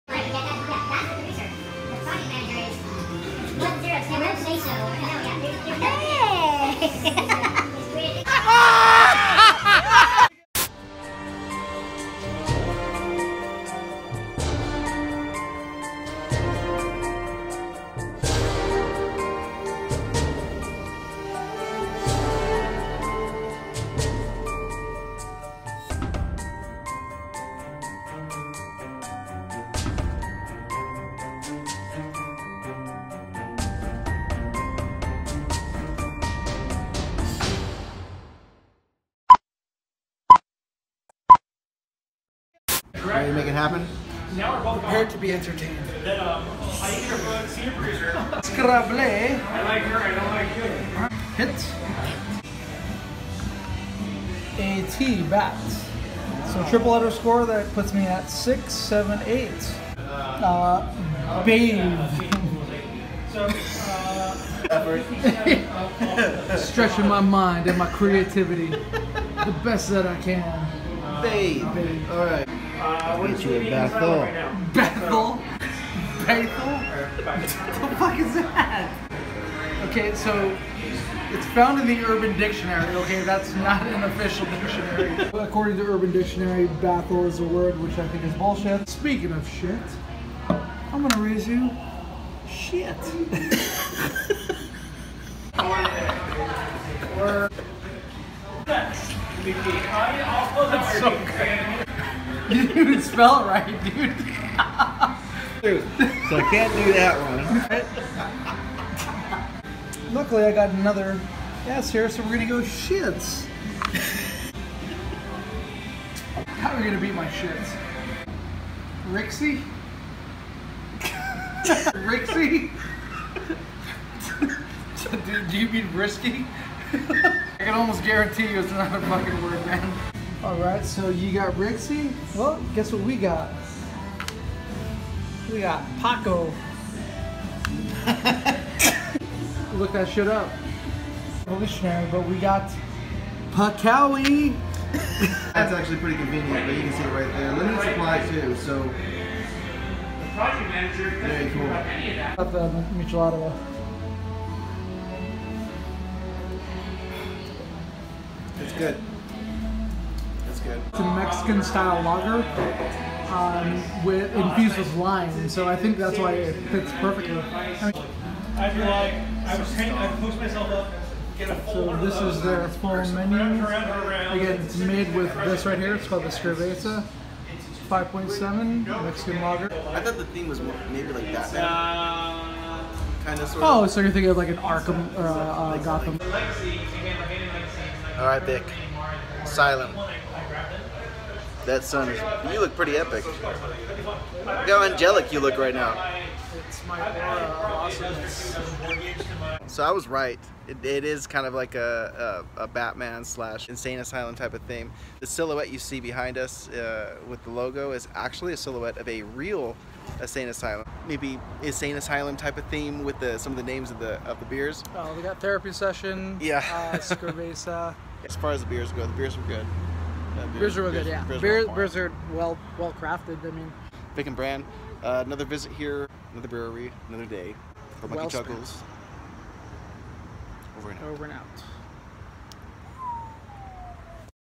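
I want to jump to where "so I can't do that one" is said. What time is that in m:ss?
1:46.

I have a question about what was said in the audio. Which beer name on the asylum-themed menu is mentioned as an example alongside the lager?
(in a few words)
Therapy Session.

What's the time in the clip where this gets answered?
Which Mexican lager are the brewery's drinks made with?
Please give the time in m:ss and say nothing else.
2:56.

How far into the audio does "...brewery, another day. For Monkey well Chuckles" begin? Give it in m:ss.
3:46.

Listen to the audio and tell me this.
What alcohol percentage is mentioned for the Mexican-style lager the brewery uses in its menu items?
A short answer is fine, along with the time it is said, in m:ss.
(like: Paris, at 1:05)
5.7, at 2:57.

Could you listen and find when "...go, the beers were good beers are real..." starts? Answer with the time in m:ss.
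3:38.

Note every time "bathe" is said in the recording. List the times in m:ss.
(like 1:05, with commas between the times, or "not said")
1:01, 1:11.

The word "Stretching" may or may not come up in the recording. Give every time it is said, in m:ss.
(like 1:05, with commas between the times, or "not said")
1:06.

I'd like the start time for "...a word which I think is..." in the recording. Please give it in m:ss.
1:27.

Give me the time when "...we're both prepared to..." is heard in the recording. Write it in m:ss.
0:44.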